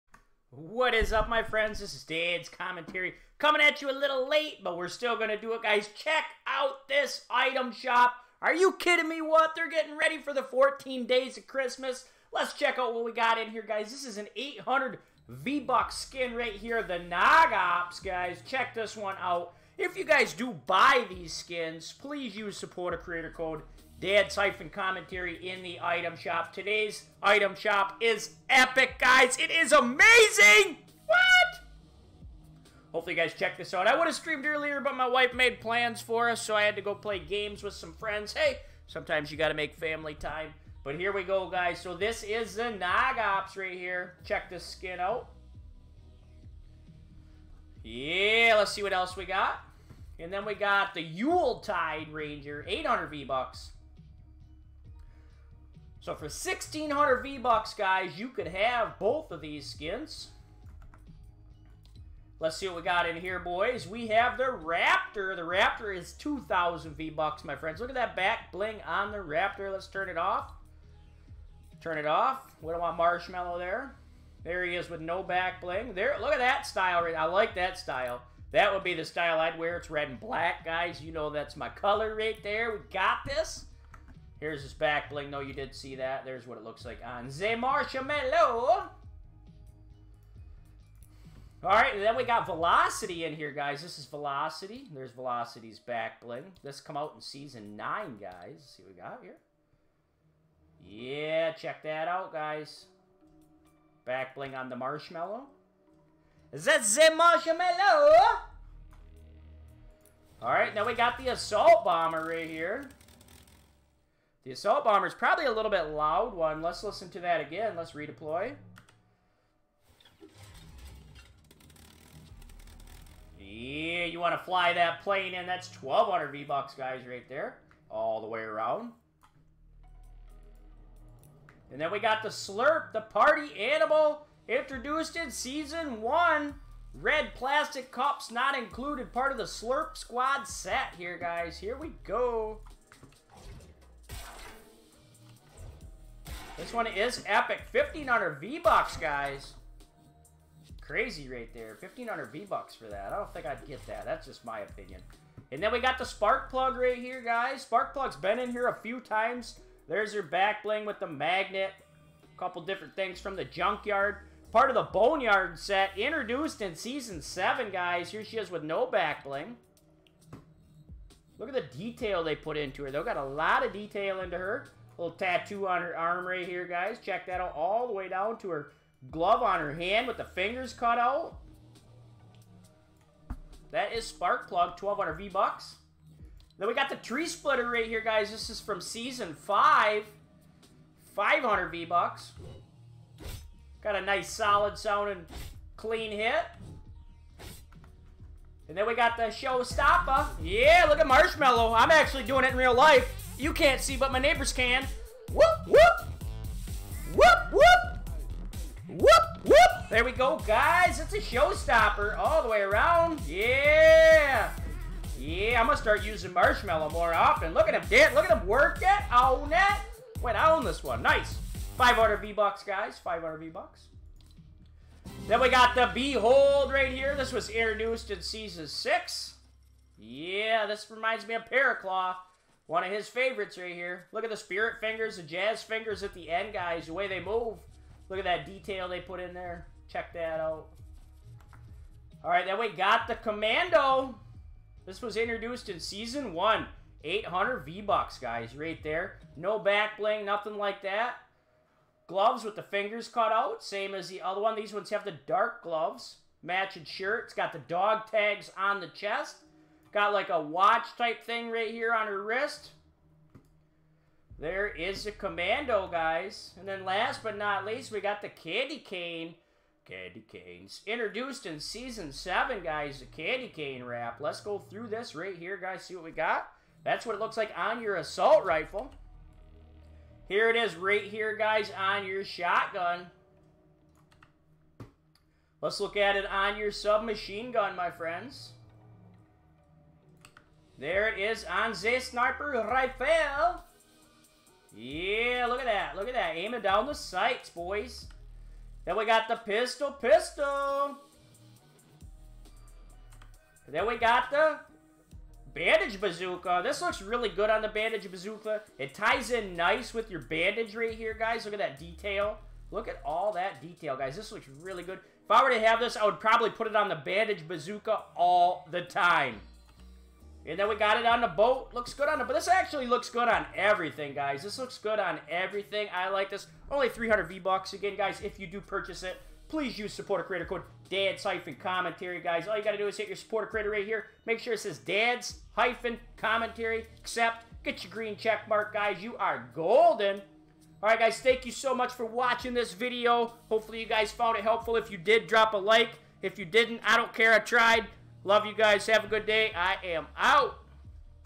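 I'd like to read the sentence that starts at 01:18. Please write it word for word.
That would be the style I'd wear.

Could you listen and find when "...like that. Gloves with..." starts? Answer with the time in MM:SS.
04:10.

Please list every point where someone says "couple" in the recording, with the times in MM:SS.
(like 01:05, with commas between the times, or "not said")
02:42.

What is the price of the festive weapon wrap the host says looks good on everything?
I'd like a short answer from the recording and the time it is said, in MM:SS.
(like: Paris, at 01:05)
300 V-Bucks, at 05:26.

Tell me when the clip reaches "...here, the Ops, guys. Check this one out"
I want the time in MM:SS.
00:16.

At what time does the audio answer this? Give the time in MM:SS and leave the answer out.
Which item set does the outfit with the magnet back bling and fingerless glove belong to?
02:44.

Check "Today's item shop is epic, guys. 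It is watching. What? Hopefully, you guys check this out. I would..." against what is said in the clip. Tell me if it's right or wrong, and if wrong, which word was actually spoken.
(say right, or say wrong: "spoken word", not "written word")
wrong: "amazing", not "watching".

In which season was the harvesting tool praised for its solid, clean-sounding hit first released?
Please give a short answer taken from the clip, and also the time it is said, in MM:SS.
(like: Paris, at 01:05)
Season 5, at 03:08.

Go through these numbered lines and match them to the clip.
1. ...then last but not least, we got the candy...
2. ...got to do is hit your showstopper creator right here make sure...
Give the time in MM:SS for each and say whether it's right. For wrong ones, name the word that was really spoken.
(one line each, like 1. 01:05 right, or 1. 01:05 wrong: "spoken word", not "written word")
1. 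04:26 right
2. 05:32 wrong: "supporter", not "showstopper".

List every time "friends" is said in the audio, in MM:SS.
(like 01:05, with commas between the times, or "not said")
00:01, 00:37, 01:07, 04:47.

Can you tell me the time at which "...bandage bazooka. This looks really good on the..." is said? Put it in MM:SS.
05:05.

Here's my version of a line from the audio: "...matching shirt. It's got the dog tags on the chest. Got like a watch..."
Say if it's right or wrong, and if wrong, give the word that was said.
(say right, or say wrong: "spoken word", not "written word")
right.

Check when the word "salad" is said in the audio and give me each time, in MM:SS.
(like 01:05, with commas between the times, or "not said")
not said.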